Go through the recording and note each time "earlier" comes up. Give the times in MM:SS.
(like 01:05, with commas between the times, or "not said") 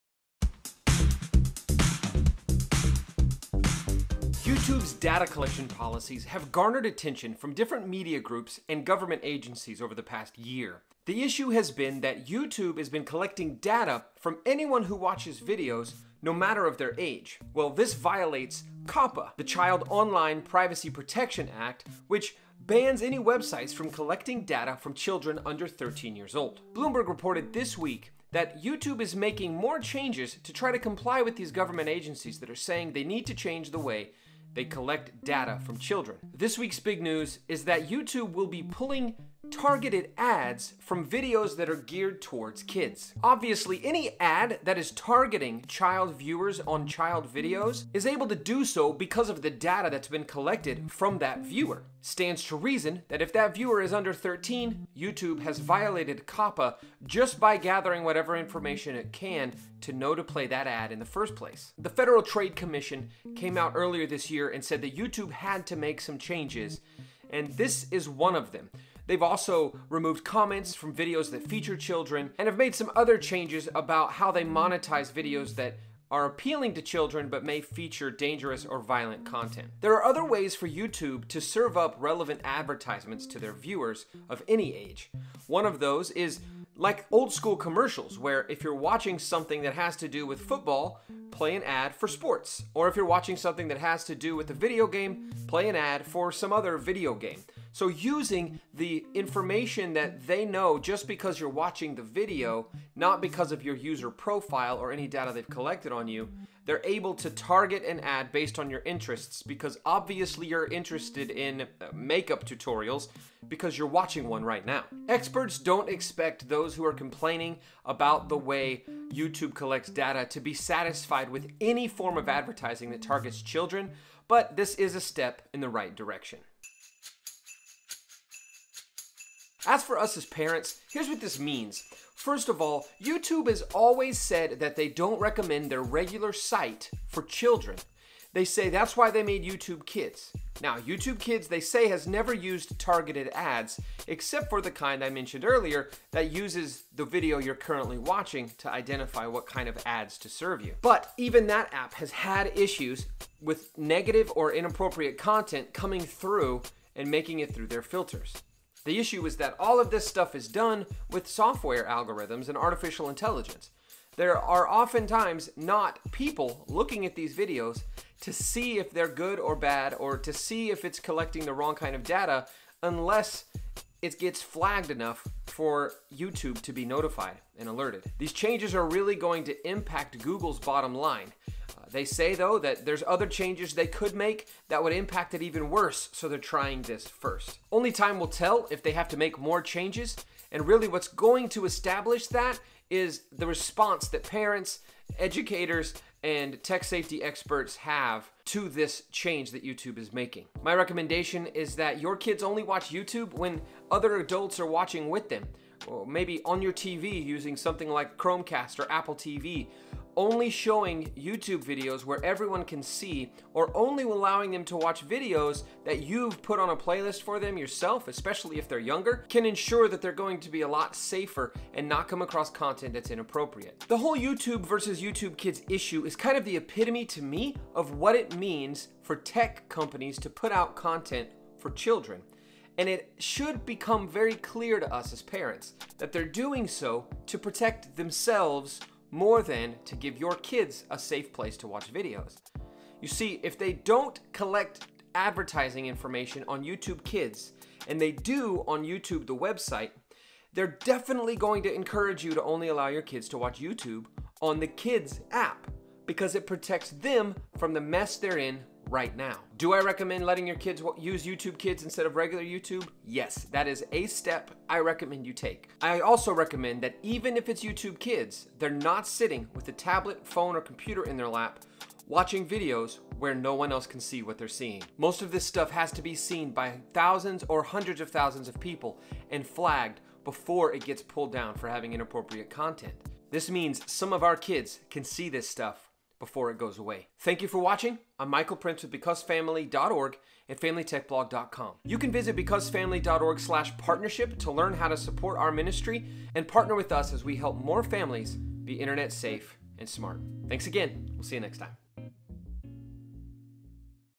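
01:03, 02:25.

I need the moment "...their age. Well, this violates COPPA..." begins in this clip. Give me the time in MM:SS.
00:16.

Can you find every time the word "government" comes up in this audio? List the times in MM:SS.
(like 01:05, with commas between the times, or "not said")
00:08, 00:31.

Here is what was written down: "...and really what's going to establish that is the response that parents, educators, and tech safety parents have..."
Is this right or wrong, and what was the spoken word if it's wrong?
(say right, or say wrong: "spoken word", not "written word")
wrong: "experts", not "parents".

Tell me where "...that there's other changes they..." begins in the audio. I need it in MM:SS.
03:02.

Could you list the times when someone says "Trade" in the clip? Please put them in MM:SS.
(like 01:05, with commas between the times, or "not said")
01:02.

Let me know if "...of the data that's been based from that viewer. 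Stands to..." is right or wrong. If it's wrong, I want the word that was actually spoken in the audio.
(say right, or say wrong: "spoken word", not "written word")
wrong: "collected", not "based".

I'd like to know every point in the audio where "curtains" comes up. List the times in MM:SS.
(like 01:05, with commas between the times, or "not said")
not said.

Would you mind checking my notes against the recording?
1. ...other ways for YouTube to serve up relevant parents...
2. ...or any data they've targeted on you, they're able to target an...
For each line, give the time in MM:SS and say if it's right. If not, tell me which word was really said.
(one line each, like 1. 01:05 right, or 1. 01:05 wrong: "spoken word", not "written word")
1. 01:20 wrong: "advertisements", not "parents"
2. 01:44 wrong: "collected", not "targeted".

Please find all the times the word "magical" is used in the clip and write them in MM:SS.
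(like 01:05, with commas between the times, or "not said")
not said.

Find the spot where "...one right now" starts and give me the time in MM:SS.
01:54.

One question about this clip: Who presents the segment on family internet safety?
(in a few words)
Michael Prince.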